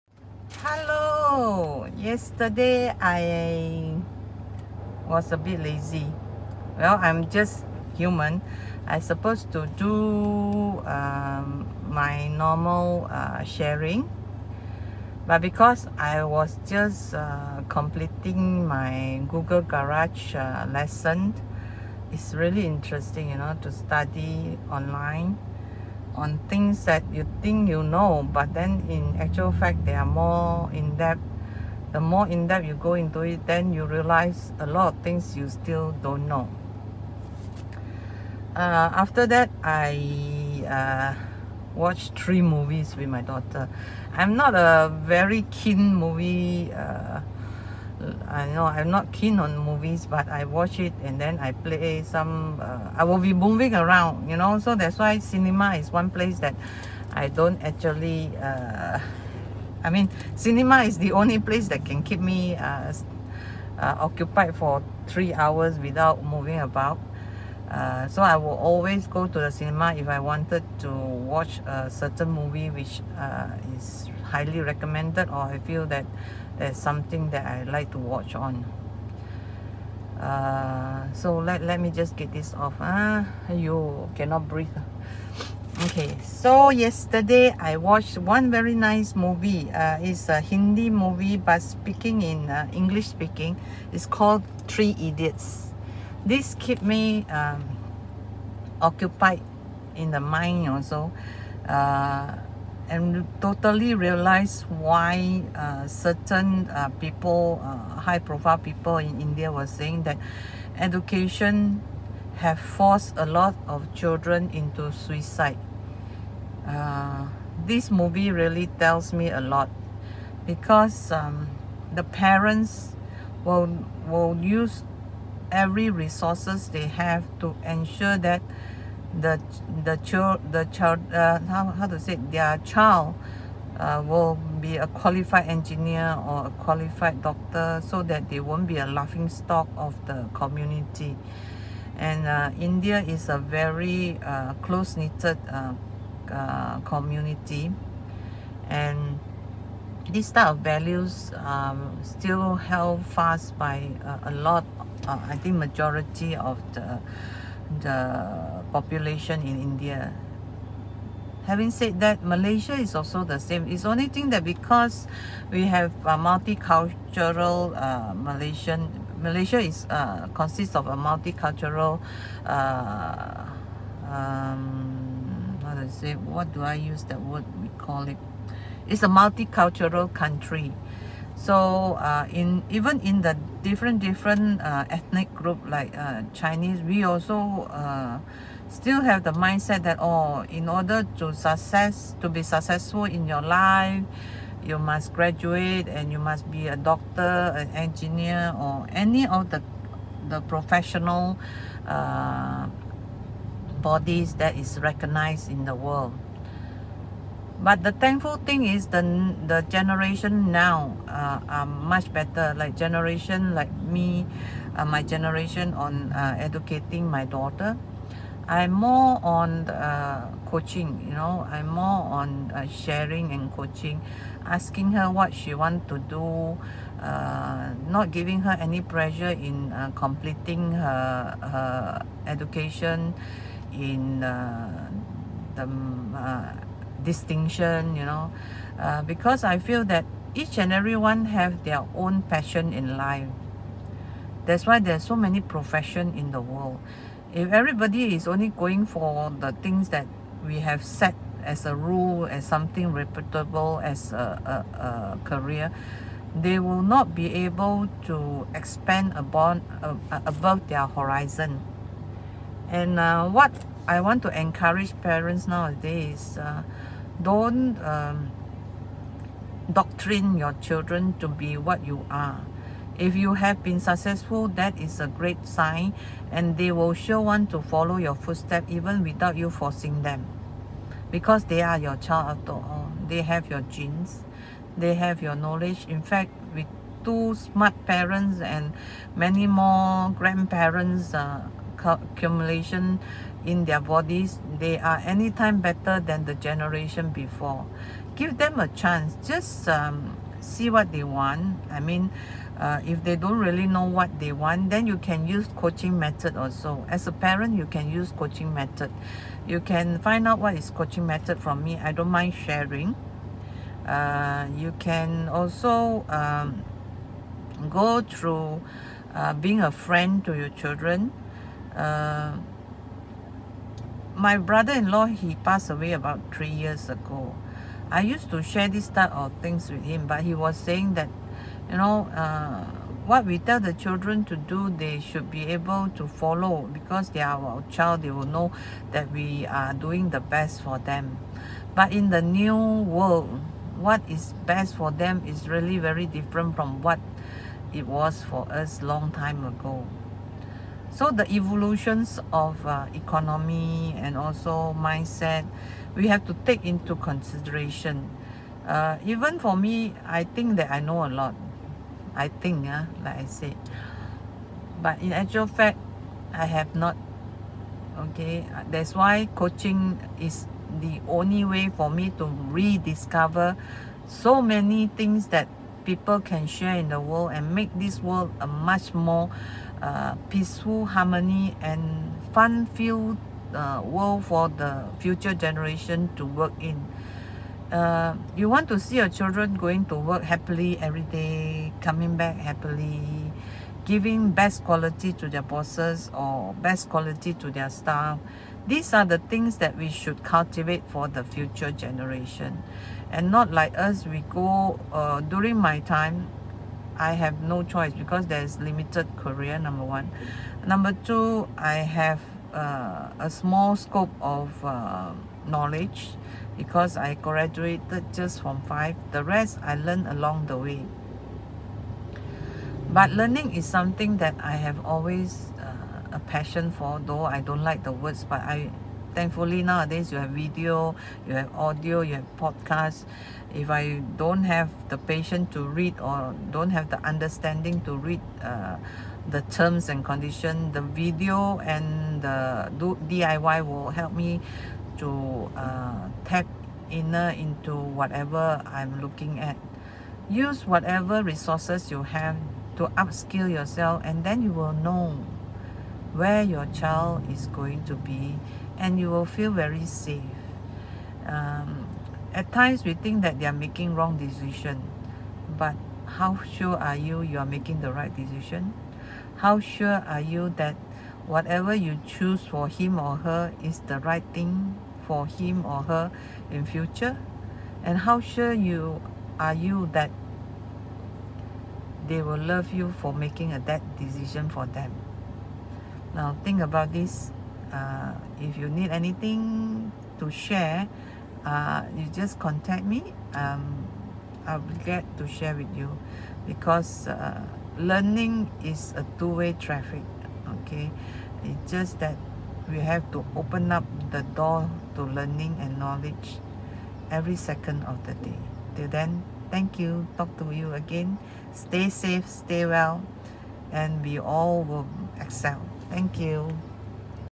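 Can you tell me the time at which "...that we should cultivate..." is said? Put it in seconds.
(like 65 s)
399 s.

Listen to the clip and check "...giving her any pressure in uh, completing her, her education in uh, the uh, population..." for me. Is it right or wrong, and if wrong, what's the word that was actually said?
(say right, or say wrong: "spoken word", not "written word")
wrong: "distinction", not "population".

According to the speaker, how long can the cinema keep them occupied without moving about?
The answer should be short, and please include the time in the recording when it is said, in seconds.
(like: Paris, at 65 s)
3 hours, at 65 s.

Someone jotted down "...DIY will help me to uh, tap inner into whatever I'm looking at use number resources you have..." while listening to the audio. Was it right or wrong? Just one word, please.
wrong.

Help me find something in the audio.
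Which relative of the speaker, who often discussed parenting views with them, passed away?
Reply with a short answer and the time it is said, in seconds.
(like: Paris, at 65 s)
brother-in-law, at 324 s.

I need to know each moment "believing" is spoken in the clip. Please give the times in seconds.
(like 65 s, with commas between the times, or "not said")
not said.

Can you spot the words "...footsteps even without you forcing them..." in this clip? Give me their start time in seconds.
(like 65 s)
278 s.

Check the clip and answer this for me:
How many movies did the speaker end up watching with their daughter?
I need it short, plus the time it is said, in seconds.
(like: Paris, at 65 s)
3, at 42 s.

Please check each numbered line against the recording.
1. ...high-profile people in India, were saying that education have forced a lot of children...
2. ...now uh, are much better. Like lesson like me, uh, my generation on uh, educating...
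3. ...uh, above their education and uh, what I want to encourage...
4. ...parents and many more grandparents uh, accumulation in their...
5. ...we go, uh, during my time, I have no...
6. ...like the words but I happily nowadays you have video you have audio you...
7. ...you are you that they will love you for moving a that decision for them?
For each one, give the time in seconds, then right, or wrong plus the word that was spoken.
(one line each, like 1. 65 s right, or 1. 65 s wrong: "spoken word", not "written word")
1. 107 s right
2. 210 s wrong: "generation", not "lesson"
3. 259 s wrong: "horizon", not "education"
4. 287 s right
5. 404 s right
6. 427 s wrong: "thankfully", not "happily"
7. 478 s wrong: "making", not "moving".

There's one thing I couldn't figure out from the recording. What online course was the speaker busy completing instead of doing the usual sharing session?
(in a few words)
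Google Garage.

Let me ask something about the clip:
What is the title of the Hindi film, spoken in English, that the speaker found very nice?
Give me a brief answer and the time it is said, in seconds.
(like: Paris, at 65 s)
Three Idiots, at 94 s.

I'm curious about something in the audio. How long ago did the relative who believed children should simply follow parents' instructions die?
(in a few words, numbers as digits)
about 3 years.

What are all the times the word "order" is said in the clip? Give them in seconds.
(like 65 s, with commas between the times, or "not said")
190 s.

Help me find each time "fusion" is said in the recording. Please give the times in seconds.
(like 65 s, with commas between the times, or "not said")
not said.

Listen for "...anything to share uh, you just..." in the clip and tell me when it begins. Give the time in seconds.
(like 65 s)
488 s.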